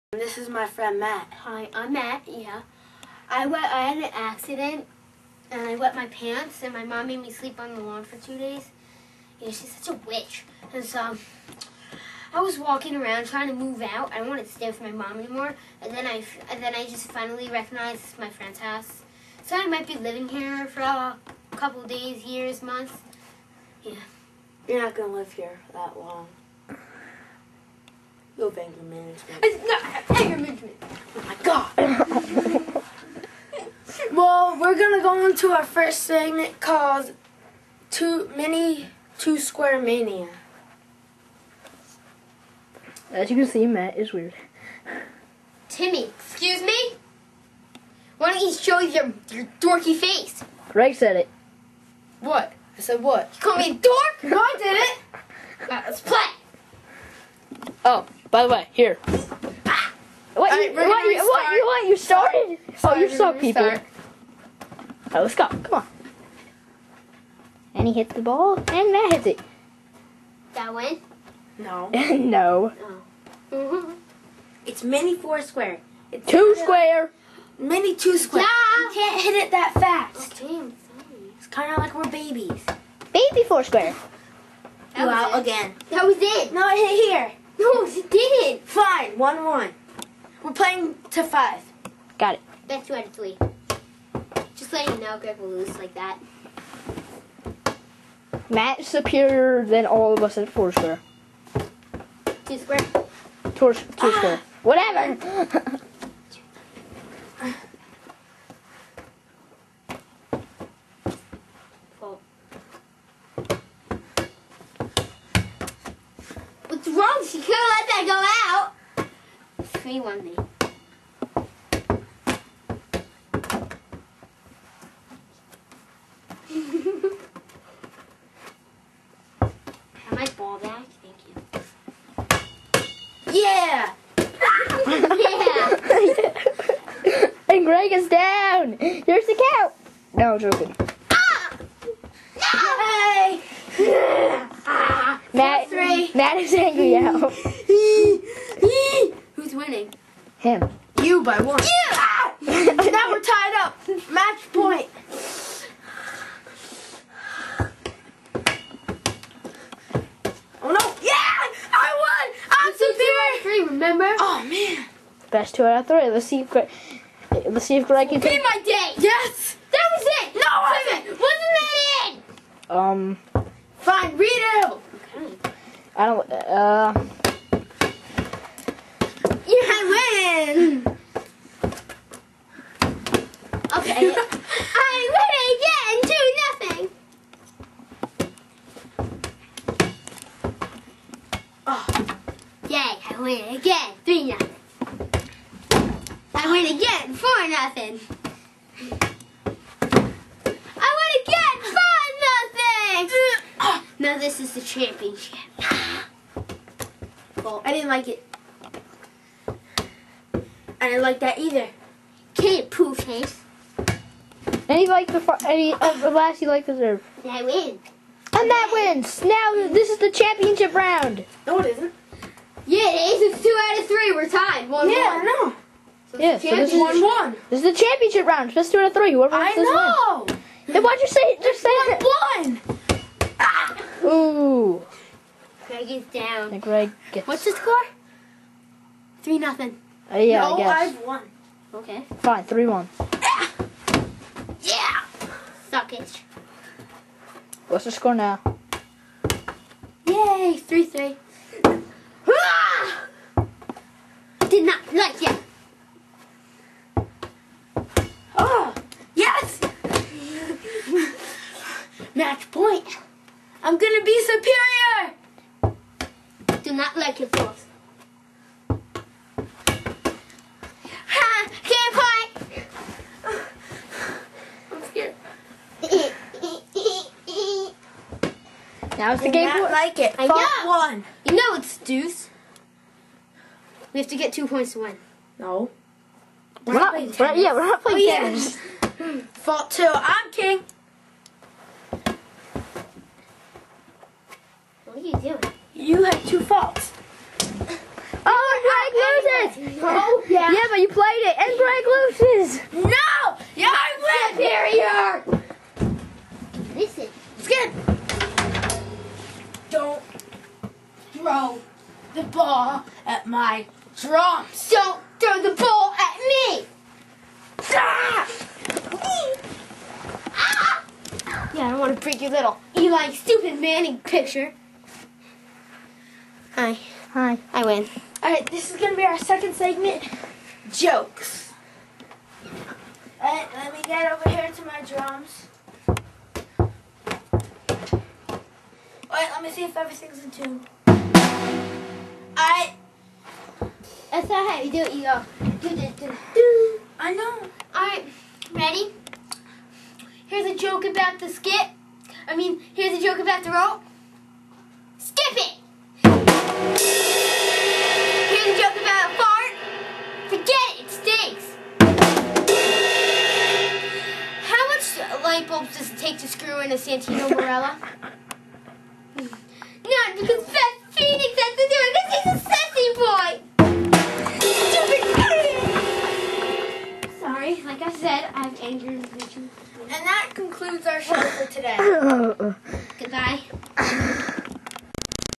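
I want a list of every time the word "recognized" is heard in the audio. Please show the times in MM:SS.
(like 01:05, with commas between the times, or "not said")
00:17.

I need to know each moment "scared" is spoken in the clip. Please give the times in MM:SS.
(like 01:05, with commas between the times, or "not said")
04:34.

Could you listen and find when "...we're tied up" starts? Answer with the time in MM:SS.
02:33.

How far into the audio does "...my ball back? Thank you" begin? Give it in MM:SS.
02:10.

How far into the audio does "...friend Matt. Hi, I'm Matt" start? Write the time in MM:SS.
00:00.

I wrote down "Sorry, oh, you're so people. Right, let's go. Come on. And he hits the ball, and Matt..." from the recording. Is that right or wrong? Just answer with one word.
right.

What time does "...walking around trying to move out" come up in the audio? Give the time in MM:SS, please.
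00:12.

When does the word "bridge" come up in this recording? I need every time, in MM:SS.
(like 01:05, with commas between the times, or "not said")
not said.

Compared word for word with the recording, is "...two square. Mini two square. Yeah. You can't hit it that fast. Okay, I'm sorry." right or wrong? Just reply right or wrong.
right.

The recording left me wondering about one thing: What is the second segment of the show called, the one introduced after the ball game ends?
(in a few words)
Jokes.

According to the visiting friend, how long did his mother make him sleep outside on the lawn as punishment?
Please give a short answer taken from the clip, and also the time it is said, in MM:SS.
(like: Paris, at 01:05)
2 days, at 00:08.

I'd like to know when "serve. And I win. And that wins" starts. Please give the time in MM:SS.
03:37.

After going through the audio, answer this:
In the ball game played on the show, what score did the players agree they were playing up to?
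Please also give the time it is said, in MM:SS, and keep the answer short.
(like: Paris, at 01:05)
5, at 01:31.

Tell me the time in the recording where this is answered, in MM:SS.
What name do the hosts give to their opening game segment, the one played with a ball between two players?
00:37.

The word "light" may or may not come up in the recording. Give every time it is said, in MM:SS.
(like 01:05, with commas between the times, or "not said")
06:05.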